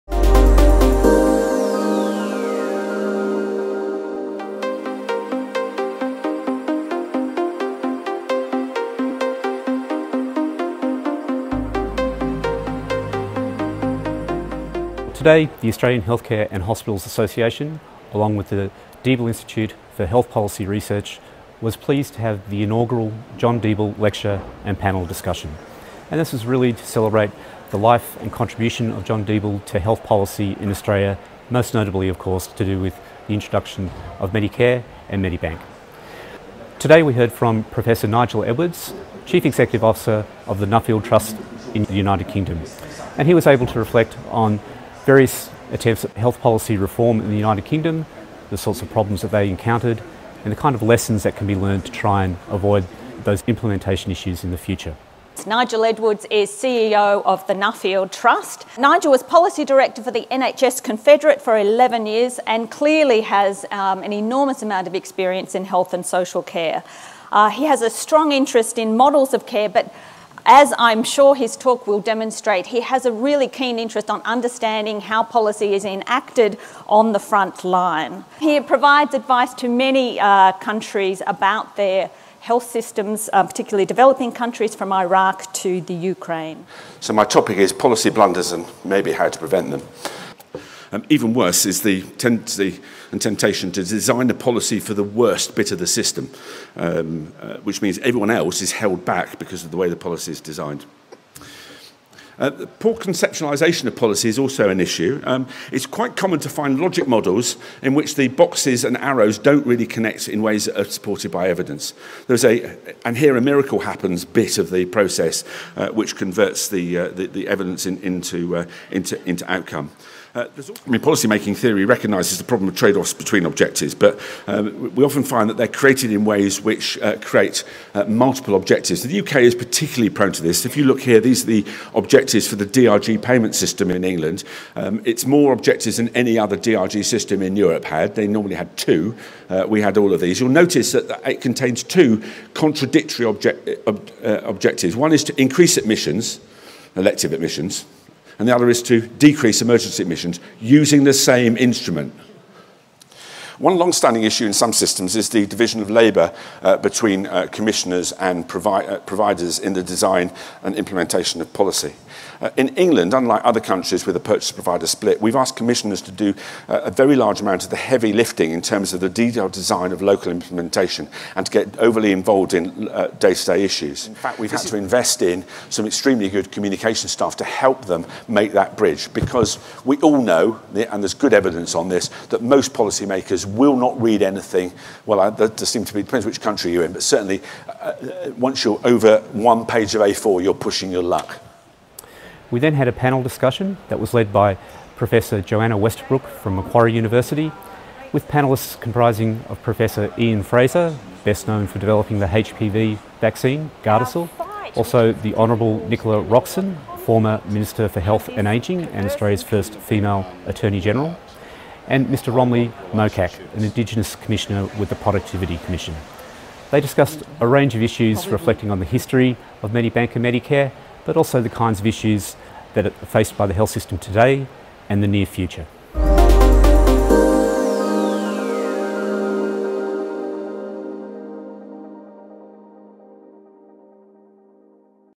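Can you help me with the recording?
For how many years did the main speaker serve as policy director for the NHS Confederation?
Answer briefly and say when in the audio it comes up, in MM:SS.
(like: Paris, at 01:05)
11, at 01:01.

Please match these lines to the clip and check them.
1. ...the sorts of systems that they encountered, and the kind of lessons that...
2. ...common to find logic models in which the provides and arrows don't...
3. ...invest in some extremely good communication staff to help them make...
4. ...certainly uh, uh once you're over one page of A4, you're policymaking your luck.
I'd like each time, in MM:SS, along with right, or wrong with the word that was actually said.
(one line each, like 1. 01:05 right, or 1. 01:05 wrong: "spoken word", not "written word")
1. 00:48 wrong: "problems", not "systems"
2. 01:46 wrong: "boxes", not "provides"
3. 02:54 right
4. 03:07 wrong: "pushing", not "policymaking".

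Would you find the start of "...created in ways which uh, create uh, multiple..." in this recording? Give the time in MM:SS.
02:05.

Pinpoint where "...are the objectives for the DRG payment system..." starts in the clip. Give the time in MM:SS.
02:11.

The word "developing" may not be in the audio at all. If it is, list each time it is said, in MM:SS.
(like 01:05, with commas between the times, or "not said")
01:23, 03:21.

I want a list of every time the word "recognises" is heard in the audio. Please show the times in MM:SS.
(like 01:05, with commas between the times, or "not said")
02:01.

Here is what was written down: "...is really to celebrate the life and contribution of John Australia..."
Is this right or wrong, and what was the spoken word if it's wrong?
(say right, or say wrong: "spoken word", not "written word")
wrong: "Deeble", not "Australia".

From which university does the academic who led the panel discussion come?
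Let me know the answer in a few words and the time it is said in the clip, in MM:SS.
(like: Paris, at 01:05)
Macquarie University, at 03:16.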